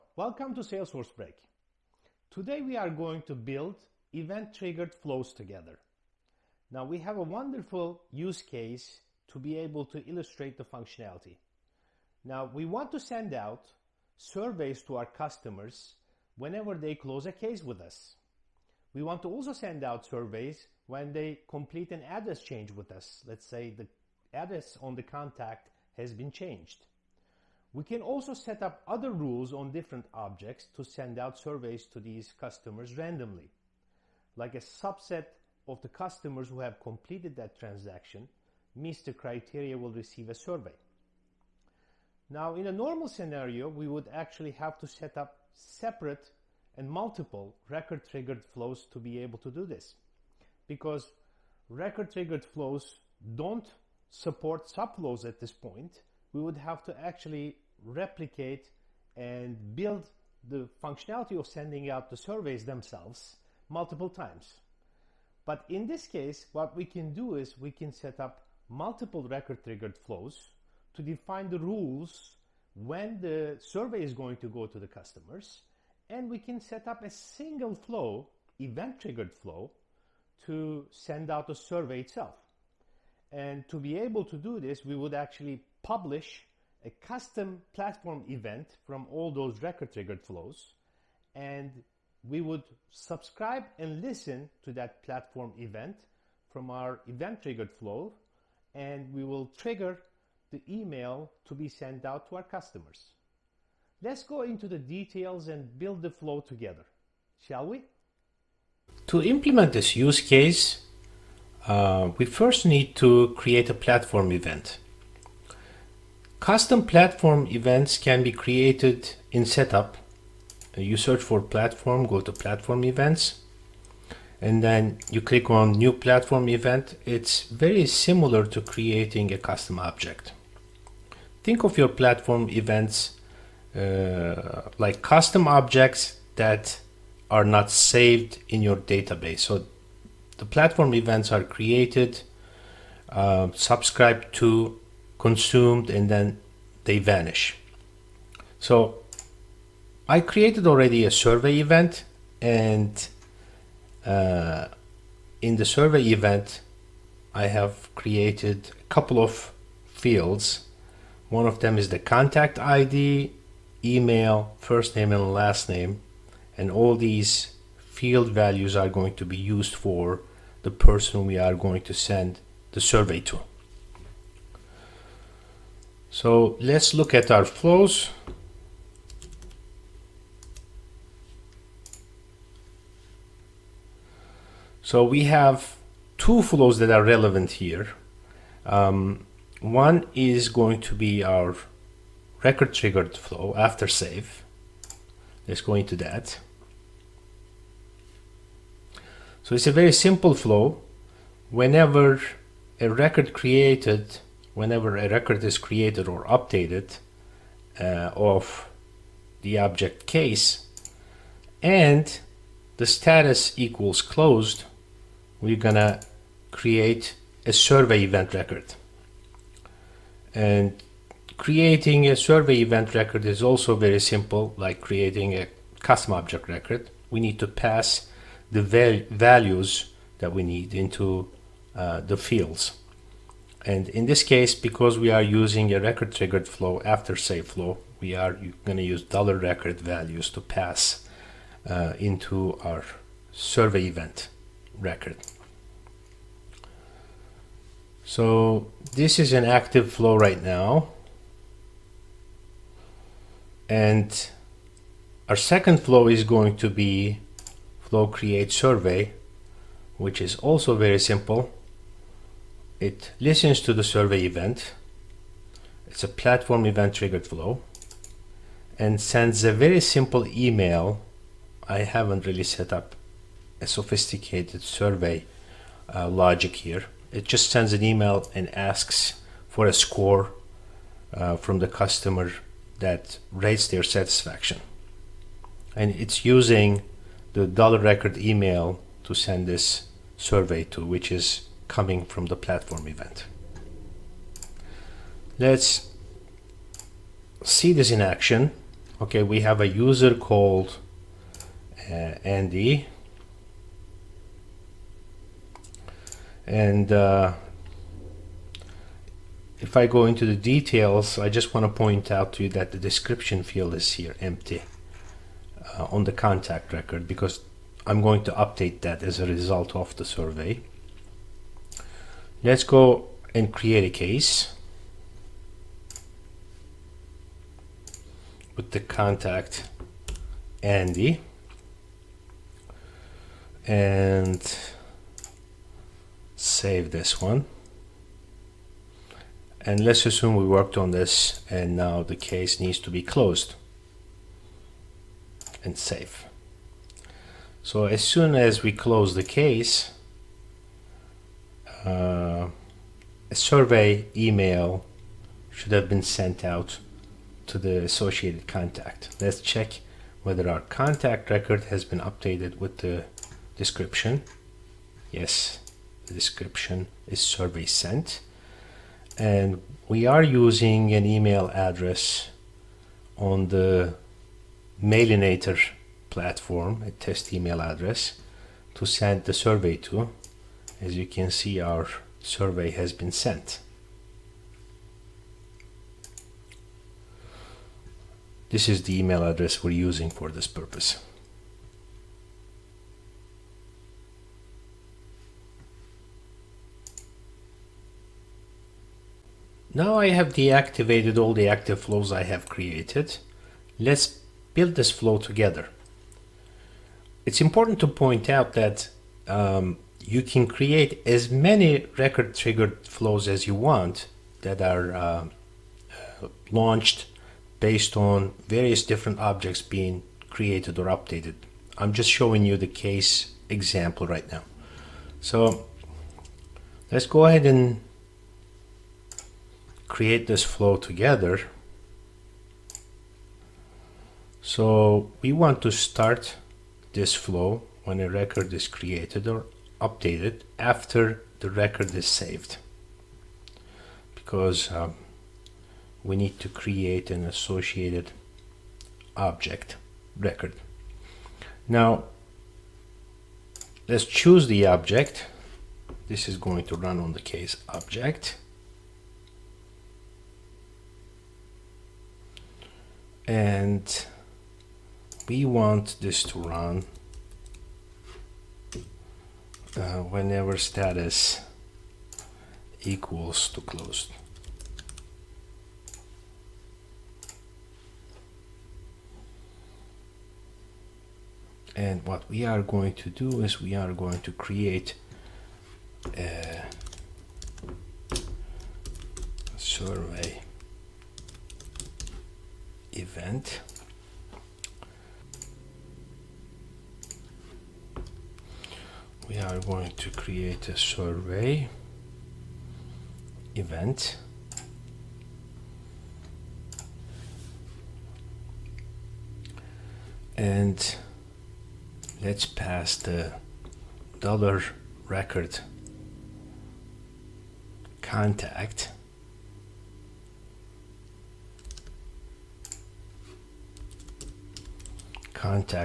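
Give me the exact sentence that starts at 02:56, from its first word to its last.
So let's look at our flows.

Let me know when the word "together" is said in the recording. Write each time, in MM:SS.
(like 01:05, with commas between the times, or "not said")
00:05, 01:46, 06:45, 07:10.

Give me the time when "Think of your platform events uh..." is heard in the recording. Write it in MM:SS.
02:11.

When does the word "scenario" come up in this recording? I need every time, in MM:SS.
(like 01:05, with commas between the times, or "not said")
00:43.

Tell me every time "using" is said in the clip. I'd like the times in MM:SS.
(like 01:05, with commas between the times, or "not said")
03:55, 04:46, 06:10, 06:29.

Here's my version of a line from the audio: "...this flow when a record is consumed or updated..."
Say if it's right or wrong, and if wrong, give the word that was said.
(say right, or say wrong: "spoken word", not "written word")
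wrong: "created", not "consumed".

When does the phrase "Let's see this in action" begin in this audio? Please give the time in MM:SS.
04:55.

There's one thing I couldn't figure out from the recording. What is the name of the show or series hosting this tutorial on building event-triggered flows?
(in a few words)
Salesforce Break.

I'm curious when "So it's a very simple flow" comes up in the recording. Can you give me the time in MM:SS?
03:19.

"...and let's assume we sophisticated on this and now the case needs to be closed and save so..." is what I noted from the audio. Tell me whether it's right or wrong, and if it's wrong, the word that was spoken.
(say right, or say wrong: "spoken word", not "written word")
wrong: "worked", not "sophisticated".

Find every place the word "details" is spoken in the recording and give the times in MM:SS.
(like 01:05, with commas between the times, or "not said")
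01:44, 05:10.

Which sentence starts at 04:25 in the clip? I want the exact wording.
It's a platform event triggered flow and sends a very simple email.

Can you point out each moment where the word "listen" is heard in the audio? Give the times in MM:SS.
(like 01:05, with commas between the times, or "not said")
01:34, 04:23.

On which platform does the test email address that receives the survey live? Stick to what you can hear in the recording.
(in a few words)
Mailinator.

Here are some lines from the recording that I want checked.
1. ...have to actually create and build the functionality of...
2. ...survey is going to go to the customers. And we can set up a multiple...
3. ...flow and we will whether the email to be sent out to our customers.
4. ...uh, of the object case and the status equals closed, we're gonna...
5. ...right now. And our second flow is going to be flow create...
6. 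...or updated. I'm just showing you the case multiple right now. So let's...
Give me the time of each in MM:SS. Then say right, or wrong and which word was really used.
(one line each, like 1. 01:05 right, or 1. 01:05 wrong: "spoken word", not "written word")
1. 00:56 wrong: "replicate", not "create"
2. 01:13 wrong: "single", not "multiple"
3. 01:37 wrong: "trigger", not "whether"
4. 03:27 right
5. 04:10 right
6. 07:00 wrong: "example", not "multiple".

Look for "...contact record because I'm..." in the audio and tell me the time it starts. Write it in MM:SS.
05:16.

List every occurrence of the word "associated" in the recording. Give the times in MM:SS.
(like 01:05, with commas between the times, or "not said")
05:57, 07:27.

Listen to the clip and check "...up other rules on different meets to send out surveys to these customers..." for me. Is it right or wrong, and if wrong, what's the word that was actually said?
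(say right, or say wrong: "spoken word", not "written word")
wrong: "objects", not "meets".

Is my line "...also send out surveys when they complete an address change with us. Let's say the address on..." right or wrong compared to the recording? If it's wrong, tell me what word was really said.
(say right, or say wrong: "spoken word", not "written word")
right.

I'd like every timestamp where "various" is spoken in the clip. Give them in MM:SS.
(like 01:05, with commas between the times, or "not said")
06:58.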